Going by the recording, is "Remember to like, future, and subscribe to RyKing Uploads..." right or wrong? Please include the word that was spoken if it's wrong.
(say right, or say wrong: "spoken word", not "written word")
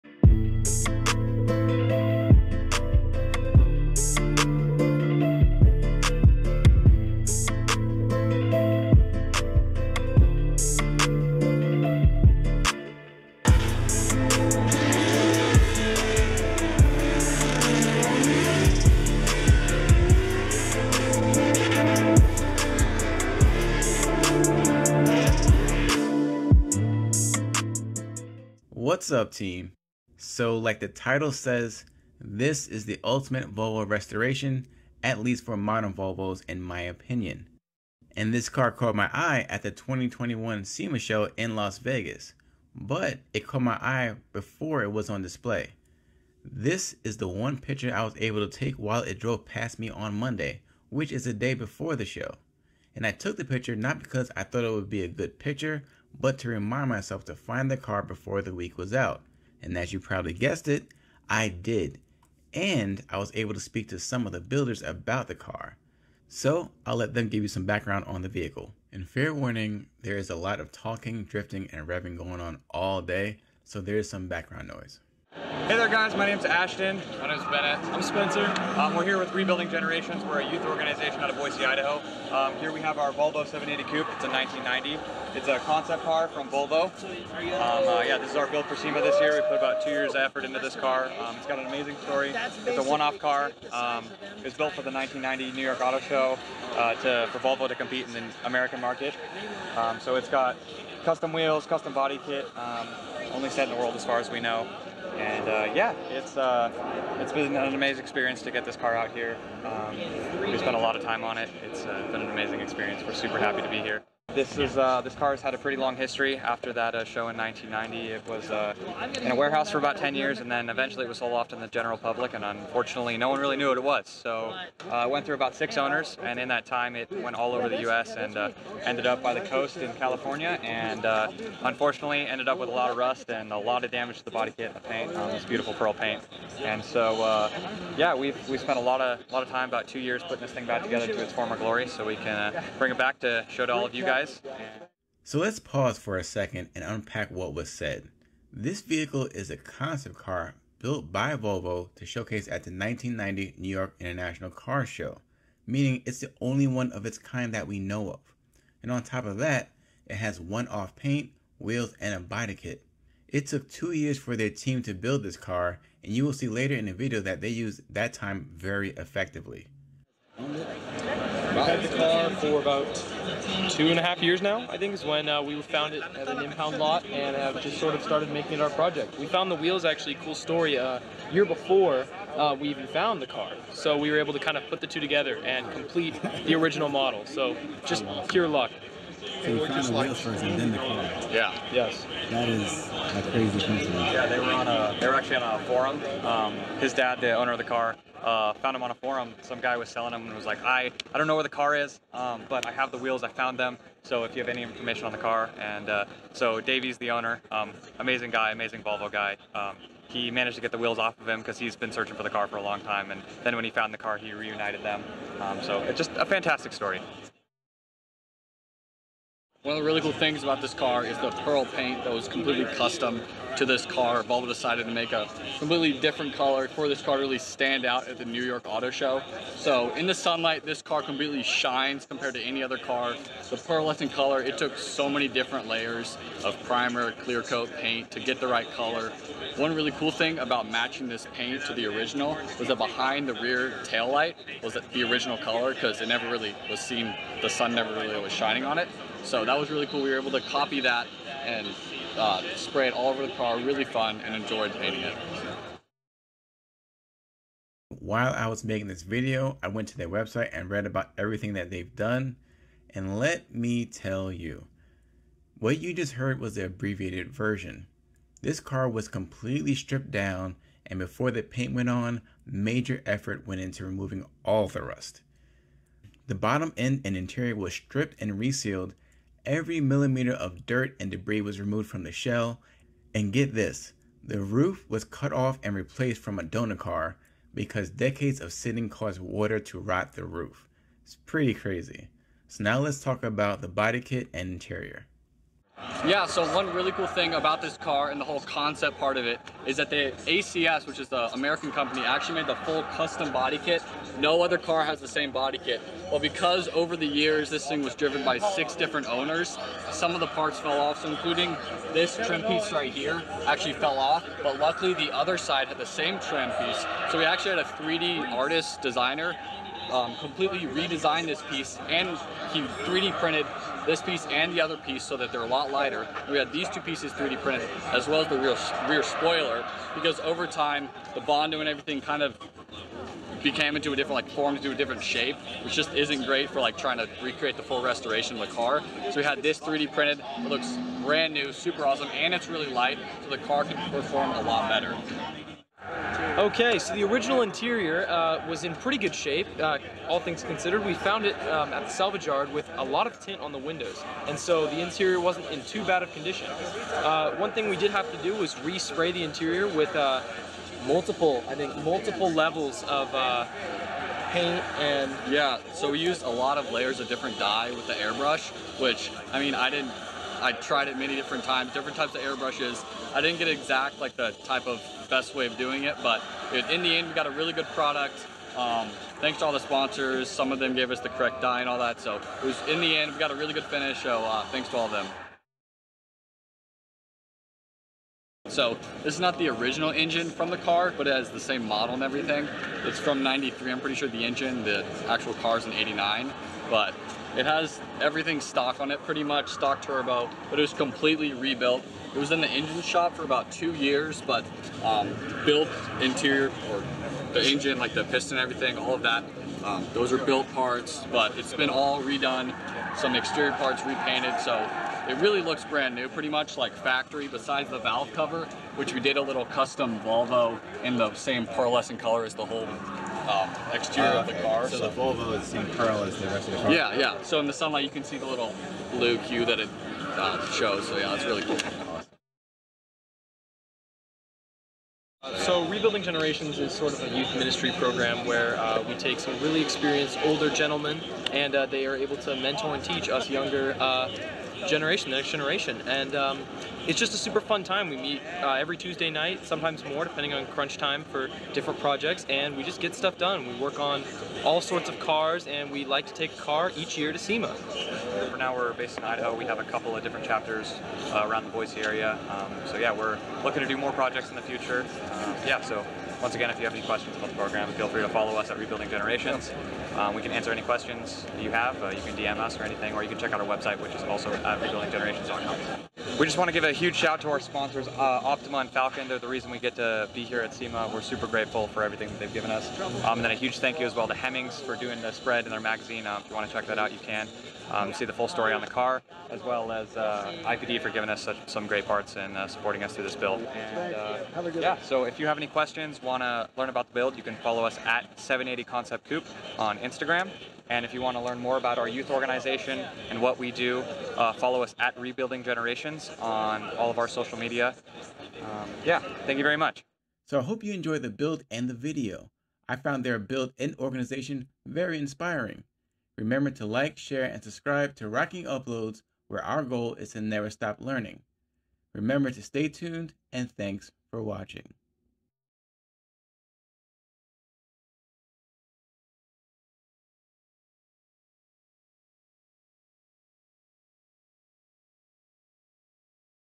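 wrong: "share", not "future".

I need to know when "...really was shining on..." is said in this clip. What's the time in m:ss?
4:07.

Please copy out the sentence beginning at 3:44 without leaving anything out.
Volvo decided to make a completely different color for this car to really stand out at the New York Auto Show.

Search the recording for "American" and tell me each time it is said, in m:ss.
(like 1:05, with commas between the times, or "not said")
1:38, 5:01.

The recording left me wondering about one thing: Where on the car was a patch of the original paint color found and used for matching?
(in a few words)
Behind the rear tail light.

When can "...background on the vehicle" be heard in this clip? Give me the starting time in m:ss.
1:07.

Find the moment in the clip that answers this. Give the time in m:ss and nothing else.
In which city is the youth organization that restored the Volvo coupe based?
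1:21.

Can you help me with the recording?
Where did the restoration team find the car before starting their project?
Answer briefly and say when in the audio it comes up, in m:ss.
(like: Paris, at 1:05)
An impound lot, at 2:56.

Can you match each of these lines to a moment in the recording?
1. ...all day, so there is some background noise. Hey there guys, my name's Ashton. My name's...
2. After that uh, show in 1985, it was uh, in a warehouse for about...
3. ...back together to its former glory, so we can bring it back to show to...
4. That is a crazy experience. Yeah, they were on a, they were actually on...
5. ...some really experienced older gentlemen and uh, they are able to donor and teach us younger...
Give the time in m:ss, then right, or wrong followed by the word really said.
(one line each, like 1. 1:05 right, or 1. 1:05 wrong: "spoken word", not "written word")
1. 1:12 right
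2. 1:56 wrong: "1990", not "1985"
3. 2:20 right
4. 3:12 wrong: "coincidence", not "experience"
5. 7:19 wrong: "mentor", not "donor".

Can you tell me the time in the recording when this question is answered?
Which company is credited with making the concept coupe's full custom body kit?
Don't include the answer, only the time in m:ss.
5:00.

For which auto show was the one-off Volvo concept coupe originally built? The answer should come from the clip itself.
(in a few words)
1990 New York Auto Show.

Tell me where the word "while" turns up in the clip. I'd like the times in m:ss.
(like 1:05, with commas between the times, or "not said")
0:48, 4:17.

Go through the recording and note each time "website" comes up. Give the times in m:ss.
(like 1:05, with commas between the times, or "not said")
4:20, 7:53.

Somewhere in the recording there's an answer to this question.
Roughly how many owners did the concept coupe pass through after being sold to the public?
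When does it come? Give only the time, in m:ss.
2:05.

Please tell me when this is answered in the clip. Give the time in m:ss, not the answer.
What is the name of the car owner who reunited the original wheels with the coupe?
3:26.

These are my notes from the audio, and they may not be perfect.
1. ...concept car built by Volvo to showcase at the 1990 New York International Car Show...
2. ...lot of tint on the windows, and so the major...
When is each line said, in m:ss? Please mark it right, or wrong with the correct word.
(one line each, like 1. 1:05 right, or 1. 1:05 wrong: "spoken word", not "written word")
1. 2:29 right
2. 5:52 wrong: "interior", not "major".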